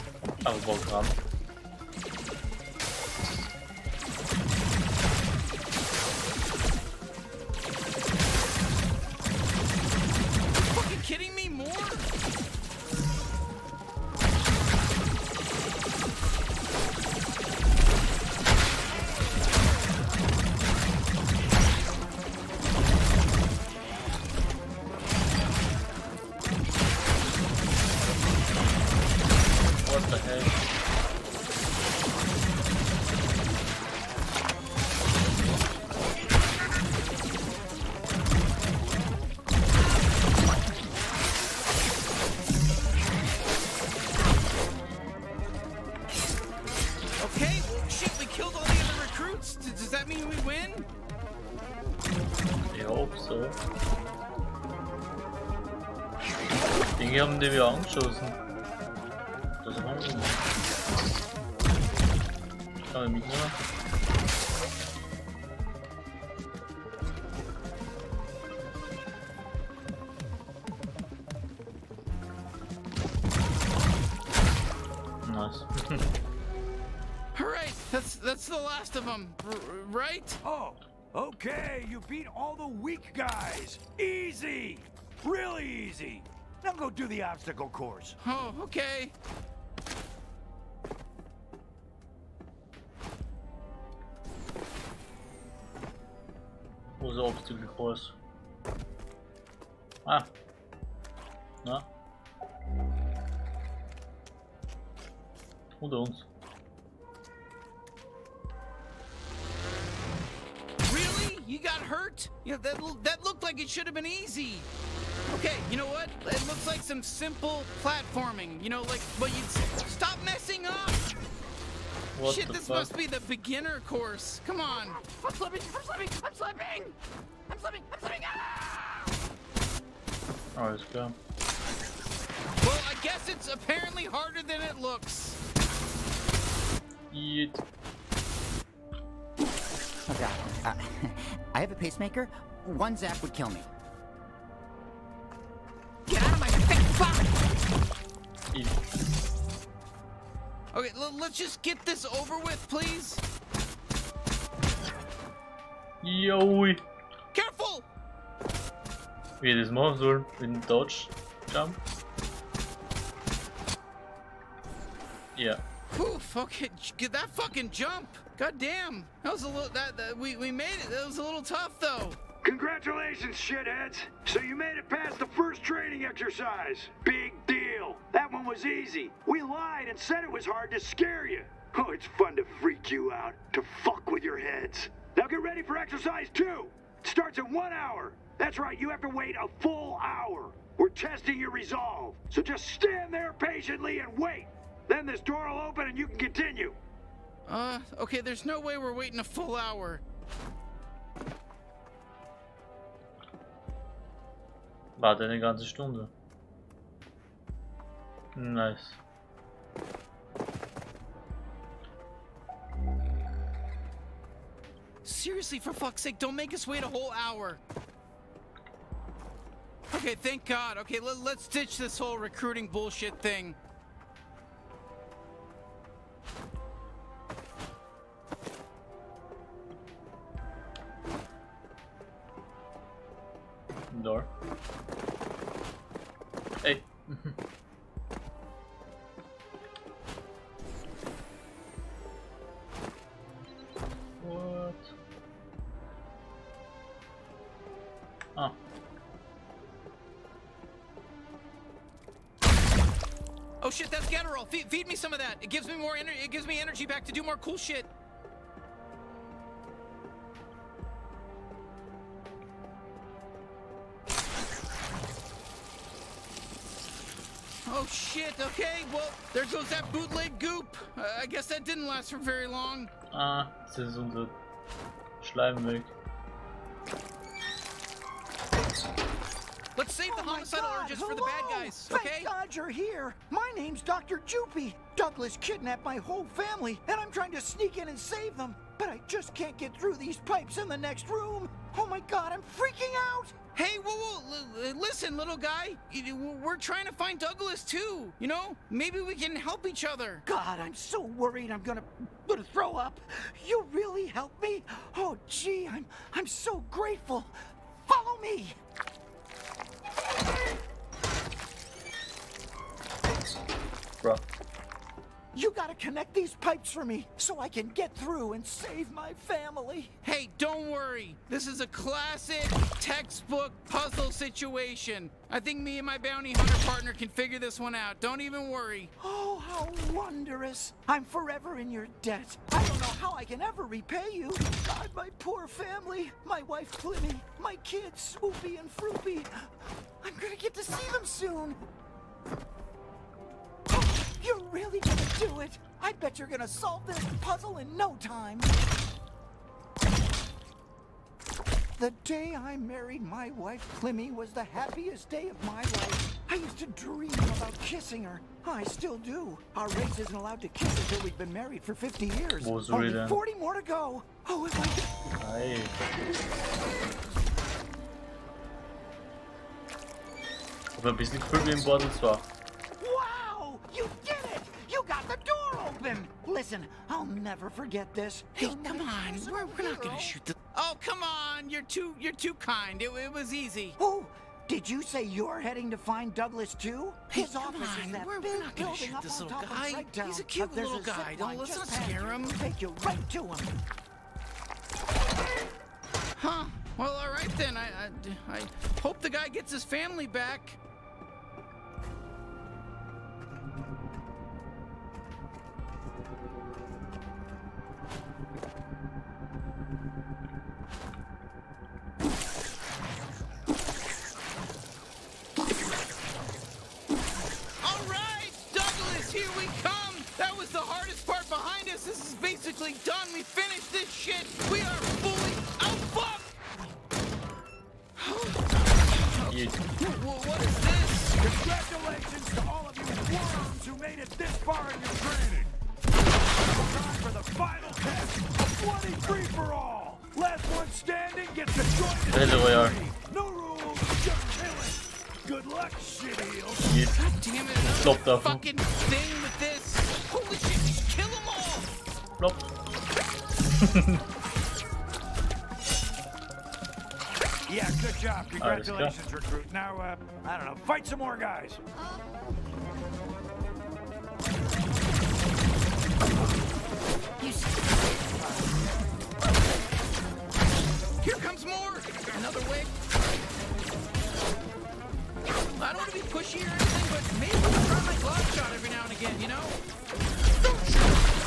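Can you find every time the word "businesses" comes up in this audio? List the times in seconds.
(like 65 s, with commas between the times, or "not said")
not said.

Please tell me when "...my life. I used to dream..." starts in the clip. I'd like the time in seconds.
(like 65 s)
355 s.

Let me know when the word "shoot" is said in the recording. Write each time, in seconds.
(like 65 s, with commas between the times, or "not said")
379 s, 388 s.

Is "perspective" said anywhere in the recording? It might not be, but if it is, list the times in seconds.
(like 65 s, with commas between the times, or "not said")
not said.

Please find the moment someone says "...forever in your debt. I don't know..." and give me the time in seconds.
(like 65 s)
331 s.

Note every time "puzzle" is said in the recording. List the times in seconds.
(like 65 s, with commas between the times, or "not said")
323 s, 347 s.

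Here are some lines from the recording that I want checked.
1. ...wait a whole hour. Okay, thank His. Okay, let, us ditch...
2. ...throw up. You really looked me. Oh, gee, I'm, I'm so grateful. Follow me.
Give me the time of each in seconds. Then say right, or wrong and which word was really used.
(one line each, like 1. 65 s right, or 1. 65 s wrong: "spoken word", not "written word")
1. 216 s wrong: "God", not "His"
2. 302 s wrong: "helped", not "looked".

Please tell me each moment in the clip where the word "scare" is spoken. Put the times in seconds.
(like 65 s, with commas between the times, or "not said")
180 s, 391 s.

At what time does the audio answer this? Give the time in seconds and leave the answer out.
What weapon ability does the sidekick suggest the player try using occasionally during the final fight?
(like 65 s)
477 s.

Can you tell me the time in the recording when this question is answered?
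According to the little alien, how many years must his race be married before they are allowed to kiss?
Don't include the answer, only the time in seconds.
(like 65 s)
361 s.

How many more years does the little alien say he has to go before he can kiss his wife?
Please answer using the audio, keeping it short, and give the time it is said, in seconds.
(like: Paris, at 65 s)
40, at 363 s.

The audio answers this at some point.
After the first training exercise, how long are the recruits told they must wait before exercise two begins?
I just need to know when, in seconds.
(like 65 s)
187 s.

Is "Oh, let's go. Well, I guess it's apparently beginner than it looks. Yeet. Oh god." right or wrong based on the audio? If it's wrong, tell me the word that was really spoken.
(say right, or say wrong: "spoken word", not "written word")
wrong: "harder", not "beginner".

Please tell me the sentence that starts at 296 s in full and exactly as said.
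We're trying to find Douglas too.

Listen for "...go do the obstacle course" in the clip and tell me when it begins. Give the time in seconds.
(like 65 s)
86 s.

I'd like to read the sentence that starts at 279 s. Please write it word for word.
save the oh homicidal God, urges hello.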